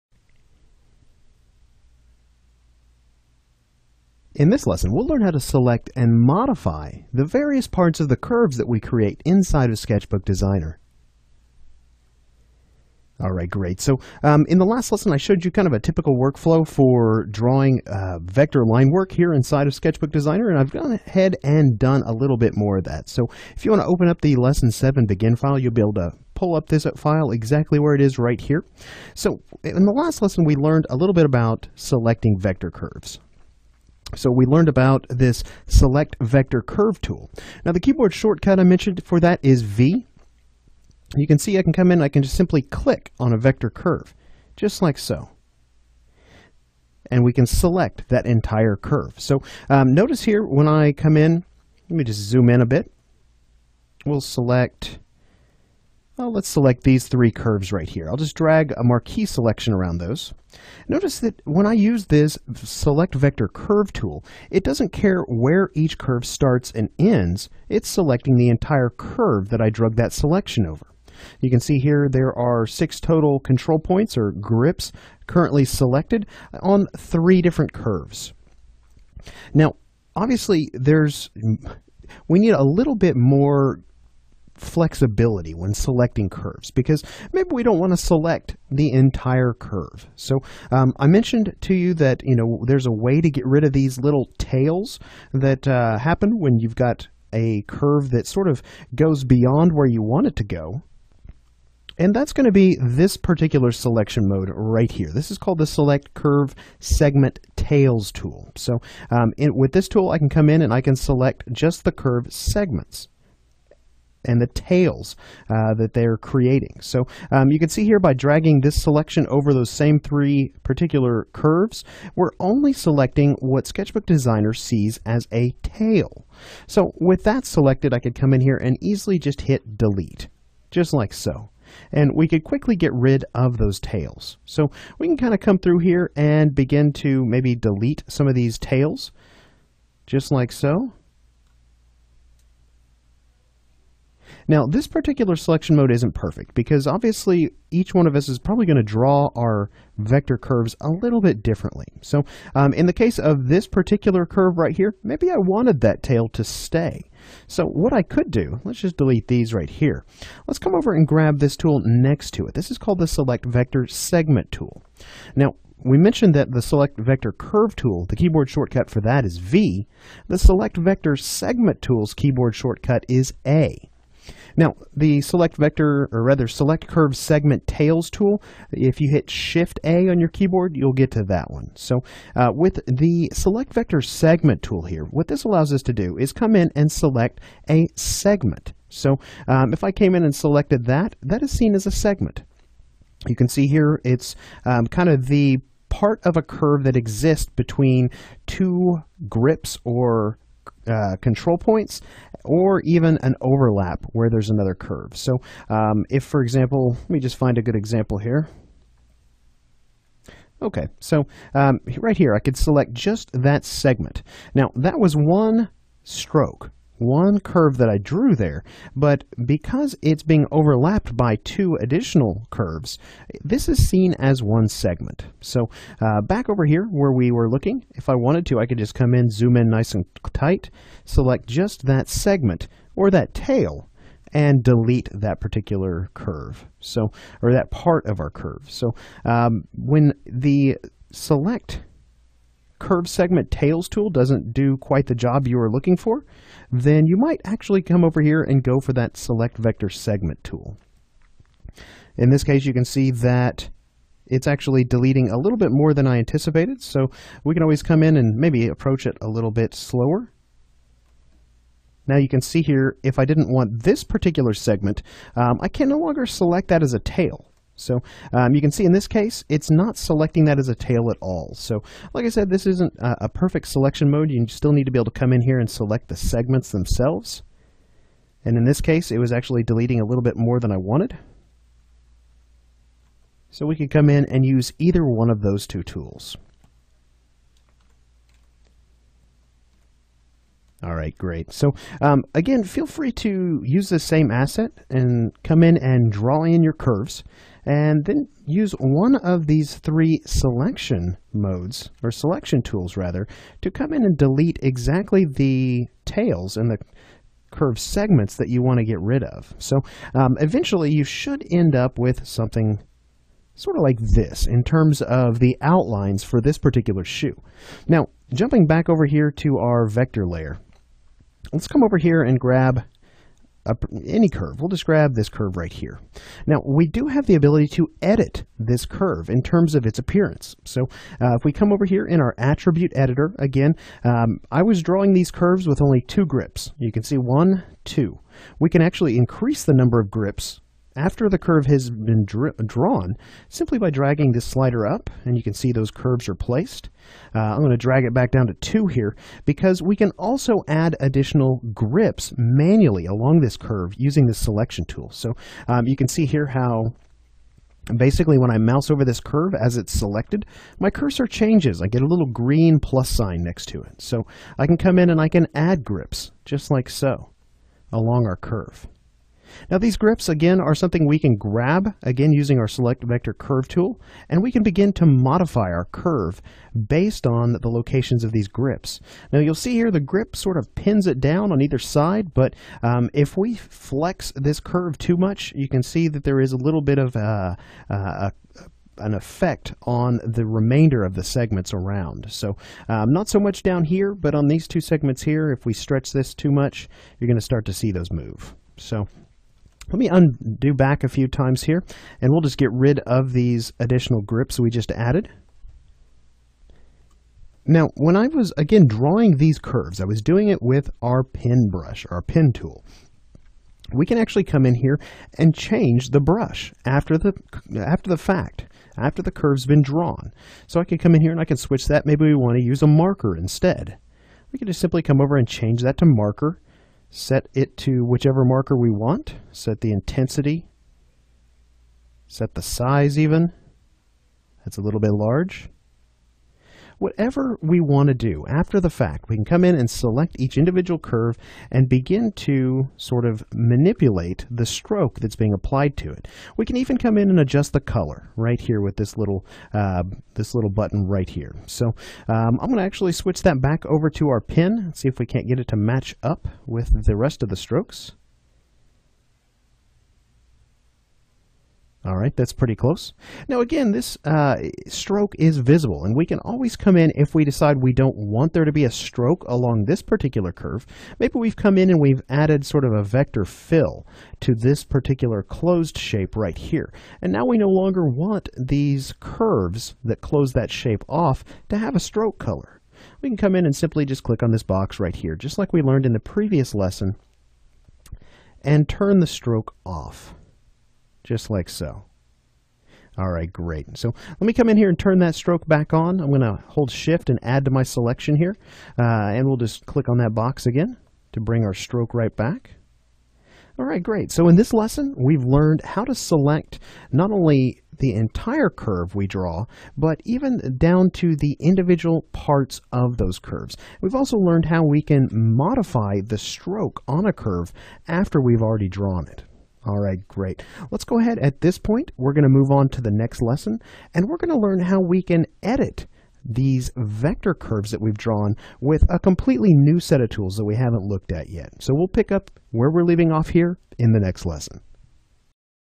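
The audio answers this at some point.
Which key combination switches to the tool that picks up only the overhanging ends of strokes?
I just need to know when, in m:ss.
2:59.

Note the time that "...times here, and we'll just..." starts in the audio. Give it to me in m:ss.
6:41.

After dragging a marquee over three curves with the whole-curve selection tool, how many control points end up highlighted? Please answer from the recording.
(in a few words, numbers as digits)
6.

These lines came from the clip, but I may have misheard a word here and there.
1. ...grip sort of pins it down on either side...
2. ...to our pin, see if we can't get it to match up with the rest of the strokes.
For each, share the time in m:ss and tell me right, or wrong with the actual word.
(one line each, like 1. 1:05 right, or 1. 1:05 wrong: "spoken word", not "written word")
1. 6:19 right
2. 7:34 right.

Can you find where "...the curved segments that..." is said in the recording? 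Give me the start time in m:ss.
5:06.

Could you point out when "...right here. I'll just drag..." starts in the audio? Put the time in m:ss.
0:57.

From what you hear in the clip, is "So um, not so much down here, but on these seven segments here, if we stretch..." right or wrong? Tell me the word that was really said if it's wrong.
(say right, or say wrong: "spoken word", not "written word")
wrong: "two", not "seven".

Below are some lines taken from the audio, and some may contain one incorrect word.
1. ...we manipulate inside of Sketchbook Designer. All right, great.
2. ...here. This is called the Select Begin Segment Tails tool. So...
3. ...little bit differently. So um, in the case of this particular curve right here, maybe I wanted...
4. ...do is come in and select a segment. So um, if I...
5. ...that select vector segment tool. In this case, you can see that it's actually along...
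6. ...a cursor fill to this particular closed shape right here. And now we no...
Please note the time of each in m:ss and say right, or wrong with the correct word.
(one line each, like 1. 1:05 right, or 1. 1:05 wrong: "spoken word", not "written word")
1. 0:08 wrong: "create", not "manipulate"
2. 1:44 wrong: "Curve", not "Begin"
3. 2:30 right
4. 3:05 right
5. 4:08 wrong: "deleting", not "along"
6. 7:52 wrong: "vector", not "cursor".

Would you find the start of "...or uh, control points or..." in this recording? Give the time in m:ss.
3:19.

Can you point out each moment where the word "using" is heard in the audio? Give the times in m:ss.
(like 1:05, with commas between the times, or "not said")
5:53, 6:12.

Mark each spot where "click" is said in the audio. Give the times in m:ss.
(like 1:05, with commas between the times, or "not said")
0:42, 8:04, 8:19.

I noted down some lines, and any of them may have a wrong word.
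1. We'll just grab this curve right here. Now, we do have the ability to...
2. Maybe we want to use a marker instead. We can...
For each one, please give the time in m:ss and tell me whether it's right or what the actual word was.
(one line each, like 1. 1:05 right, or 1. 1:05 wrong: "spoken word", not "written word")
1. 5:24 right
2. 7:02 right.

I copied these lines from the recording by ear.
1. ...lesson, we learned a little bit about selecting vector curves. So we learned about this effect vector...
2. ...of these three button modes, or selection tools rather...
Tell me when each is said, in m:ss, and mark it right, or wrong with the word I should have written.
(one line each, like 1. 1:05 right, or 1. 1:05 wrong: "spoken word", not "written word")
1. 0:30 wrong: "select", not "effect"
2. 4:59 wrong: "selection", not "button".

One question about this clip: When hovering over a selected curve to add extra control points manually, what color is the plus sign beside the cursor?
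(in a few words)
Green.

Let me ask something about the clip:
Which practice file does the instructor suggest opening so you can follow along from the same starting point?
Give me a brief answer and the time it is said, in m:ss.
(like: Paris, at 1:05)
Lesson 7 Begin, at 0:24.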